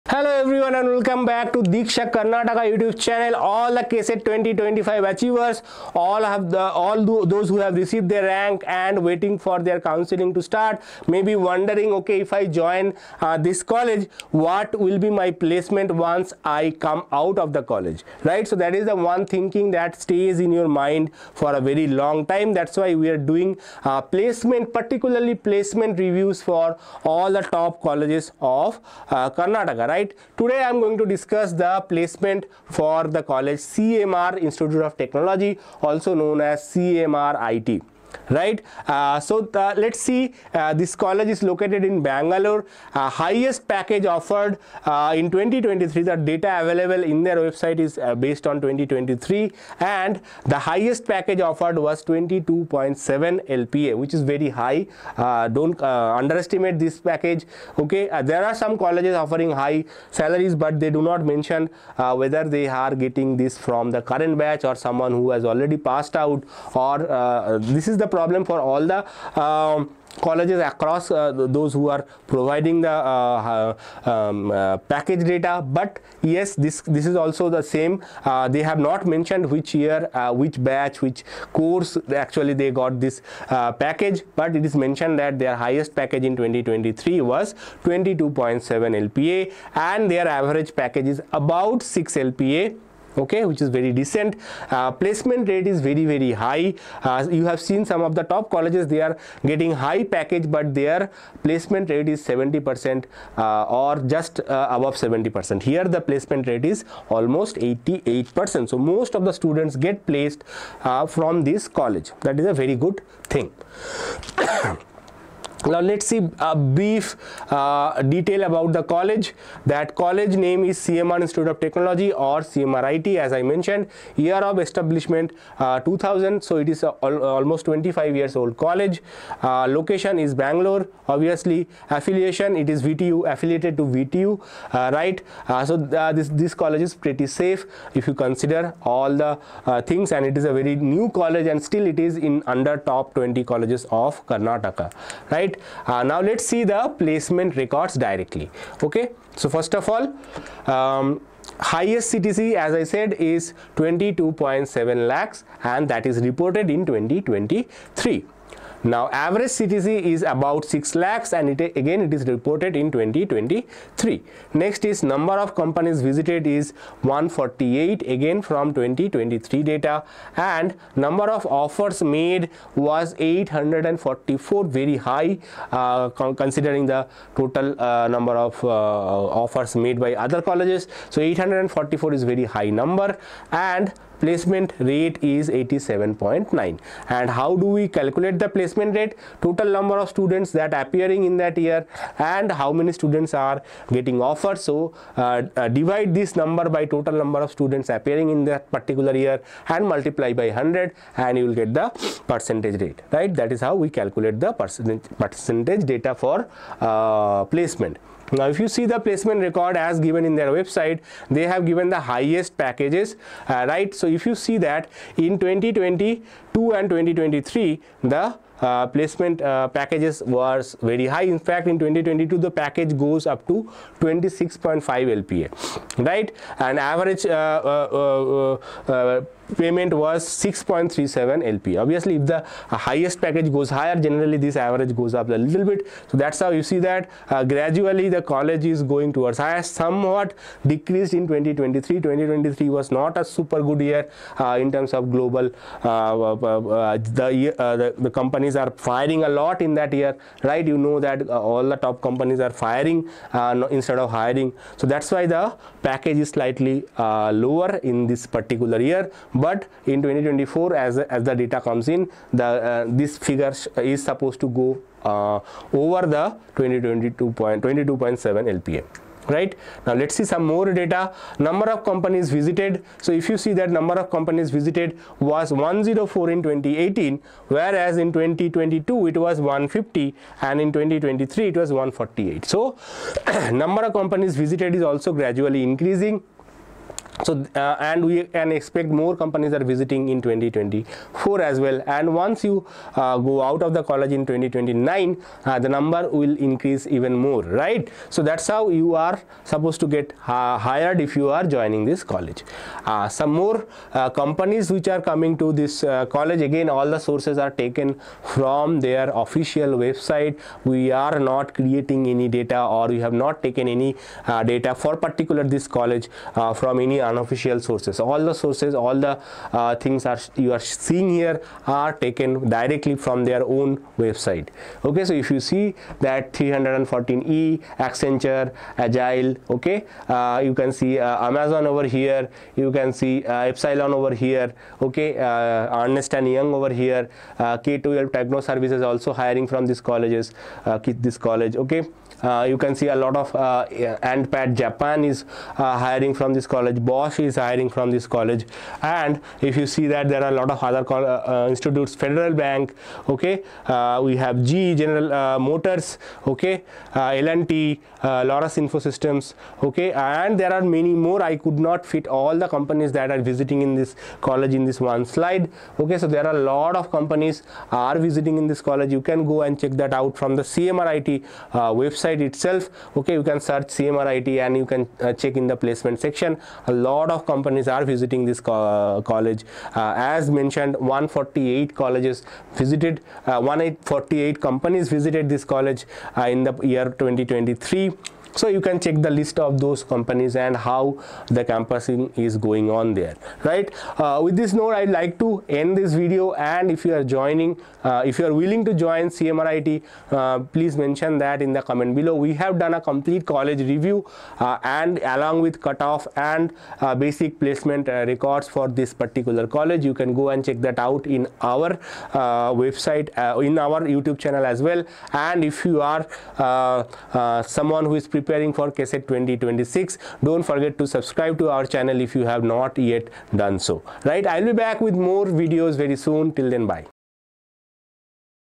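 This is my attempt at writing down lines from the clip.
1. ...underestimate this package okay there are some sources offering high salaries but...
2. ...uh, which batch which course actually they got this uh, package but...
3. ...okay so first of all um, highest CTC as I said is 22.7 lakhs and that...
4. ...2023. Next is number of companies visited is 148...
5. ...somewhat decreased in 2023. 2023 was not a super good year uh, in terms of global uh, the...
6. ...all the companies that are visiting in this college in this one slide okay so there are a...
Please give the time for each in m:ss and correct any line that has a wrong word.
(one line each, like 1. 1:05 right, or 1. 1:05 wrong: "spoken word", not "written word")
1. 0:55 wrong: "colleges", not "sources"
2. 1:20 right
3. 2:28 right
4. 2:42 right
5. 3:59 right
6. 6:02 right.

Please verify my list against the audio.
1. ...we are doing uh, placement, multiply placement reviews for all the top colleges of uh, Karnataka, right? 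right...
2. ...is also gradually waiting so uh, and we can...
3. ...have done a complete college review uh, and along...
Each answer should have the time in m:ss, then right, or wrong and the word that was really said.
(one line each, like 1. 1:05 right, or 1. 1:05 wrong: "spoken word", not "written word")
1. 0:22 wrong: "particularly", not "multiply"
2. 4:44 wrong: "increasing", not "waiting"
3. 6:42 right.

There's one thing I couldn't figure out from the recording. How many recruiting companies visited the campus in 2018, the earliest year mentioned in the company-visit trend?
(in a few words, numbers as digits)
104.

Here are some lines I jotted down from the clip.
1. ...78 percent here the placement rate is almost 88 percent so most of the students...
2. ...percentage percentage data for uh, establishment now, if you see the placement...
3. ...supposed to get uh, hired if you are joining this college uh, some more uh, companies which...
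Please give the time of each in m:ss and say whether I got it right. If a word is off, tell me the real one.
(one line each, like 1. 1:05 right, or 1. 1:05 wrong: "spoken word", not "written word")
1. 1:44 wrong: "70", not "78"
2. 3:24 wrong: "placement", not "establishment"
3. 4:59 right.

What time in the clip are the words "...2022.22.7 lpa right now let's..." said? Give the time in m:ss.
4:26.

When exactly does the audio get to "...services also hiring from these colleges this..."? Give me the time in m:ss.
5:38.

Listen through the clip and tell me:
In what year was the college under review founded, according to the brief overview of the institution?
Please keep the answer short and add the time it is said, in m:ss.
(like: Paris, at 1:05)
2000, at 2:05.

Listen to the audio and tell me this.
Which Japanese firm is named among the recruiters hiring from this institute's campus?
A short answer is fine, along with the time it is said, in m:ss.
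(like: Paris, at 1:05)
Andpad Japan, at 5:44.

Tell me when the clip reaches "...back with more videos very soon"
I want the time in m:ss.
7:04.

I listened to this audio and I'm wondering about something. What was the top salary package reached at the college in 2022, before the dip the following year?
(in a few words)
26.5 LPA.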